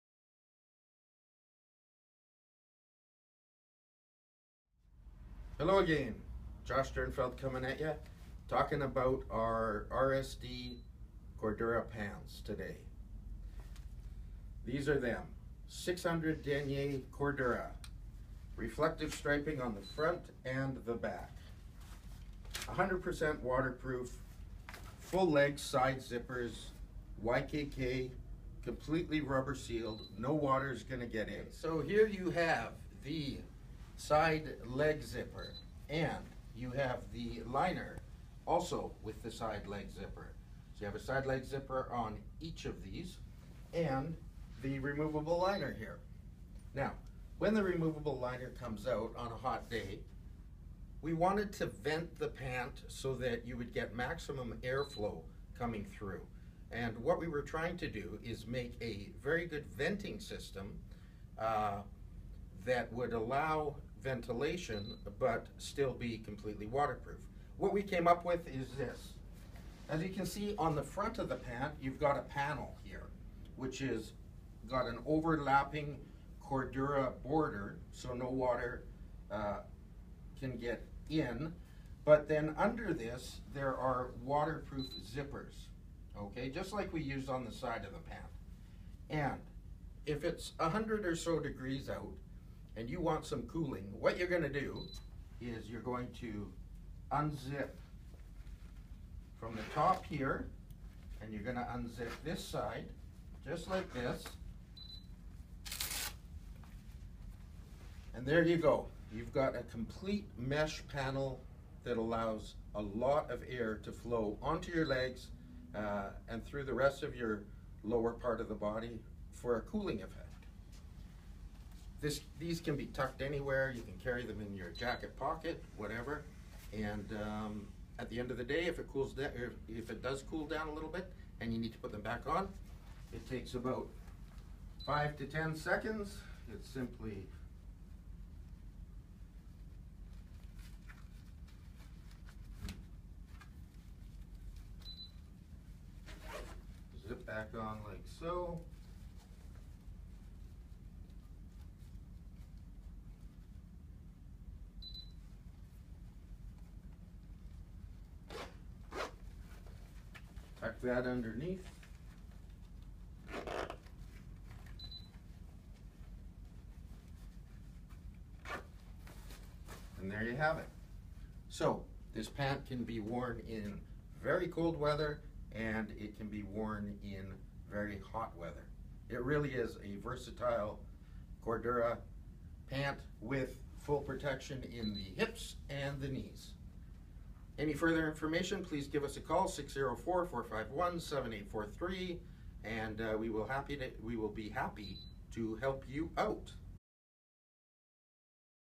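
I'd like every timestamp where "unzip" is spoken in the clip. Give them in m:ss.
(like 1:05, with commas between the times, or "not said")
1:37, 1:41.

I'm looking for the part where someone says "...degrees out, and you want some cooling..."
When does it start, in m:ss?
1:31.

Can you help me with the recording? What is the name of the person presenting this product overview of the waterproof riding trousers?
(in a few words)
Josh Sternfeld.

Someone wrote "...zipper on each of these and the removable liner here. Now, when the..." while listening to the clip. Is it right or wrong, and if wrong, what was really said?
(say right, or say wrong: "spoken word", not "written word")
right.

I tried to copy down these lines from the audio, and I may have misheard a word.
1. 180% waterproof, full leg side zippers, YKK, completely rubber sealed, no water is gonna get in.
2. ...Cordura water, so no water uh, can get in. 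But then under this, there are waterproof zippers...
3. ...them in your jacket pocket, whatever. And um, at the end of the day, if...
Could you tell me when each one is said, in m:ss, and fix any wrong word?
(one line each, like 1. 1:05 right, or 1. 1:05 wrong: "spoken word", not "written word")
1. 0:22 wrong: "100", not "180"
2. 1:16 wrong: "border", not "water"
3. 2:04 right.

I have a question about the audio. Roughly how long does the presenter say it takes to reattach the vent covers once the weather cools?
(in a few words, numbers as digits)
5 to 10 seconds.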